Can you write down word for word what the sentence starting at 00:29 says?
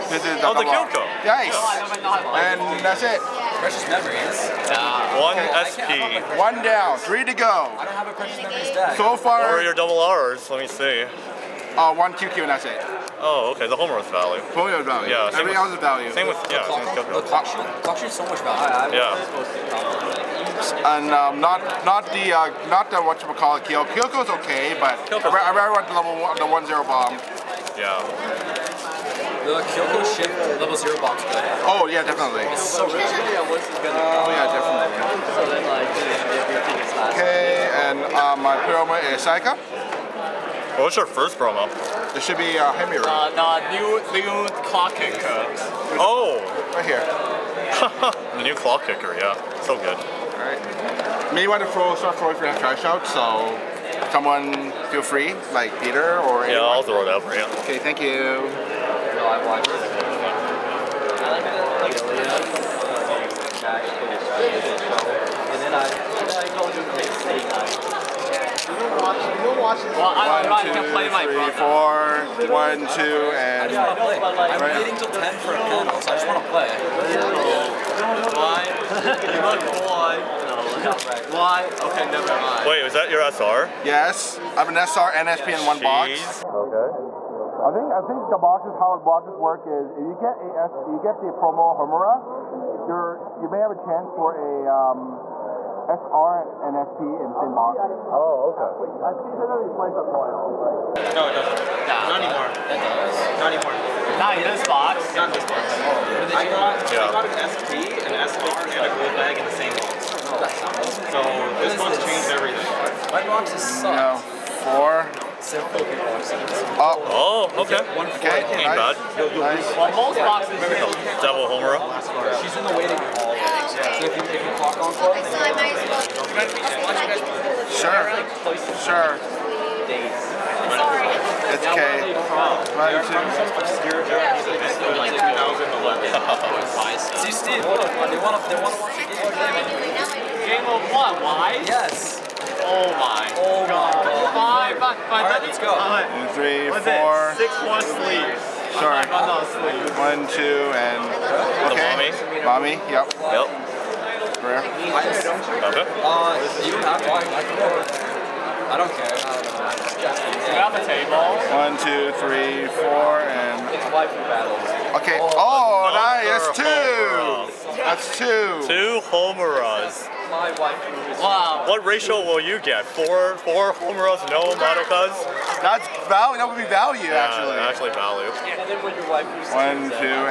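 The Kyoko ship level zero bomb's good.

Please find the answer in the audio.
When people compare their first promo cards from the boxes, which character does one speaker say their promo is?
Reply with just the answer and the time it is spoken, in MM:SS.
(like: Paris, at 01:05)
Saika, at 00:39.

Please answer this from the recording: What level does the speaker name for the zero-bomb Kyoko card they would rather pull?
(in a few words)
level one.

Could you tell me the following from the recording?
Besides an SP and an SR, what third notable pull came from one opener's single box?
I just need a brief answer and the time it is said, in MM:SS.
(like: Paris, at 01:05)
a gold bag, at 01:48.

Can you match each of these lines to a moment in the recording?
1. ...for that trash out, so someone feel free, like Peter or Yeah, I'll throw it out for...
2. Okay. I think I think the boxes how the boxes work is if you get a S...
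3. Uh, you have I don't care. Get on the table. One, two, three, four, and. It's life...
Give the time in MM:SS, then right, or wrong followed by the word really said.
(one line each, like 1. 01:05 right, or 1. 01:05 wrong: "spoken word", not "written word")
1. 00:52 right
2. 01:26 right
3. 02:35 right.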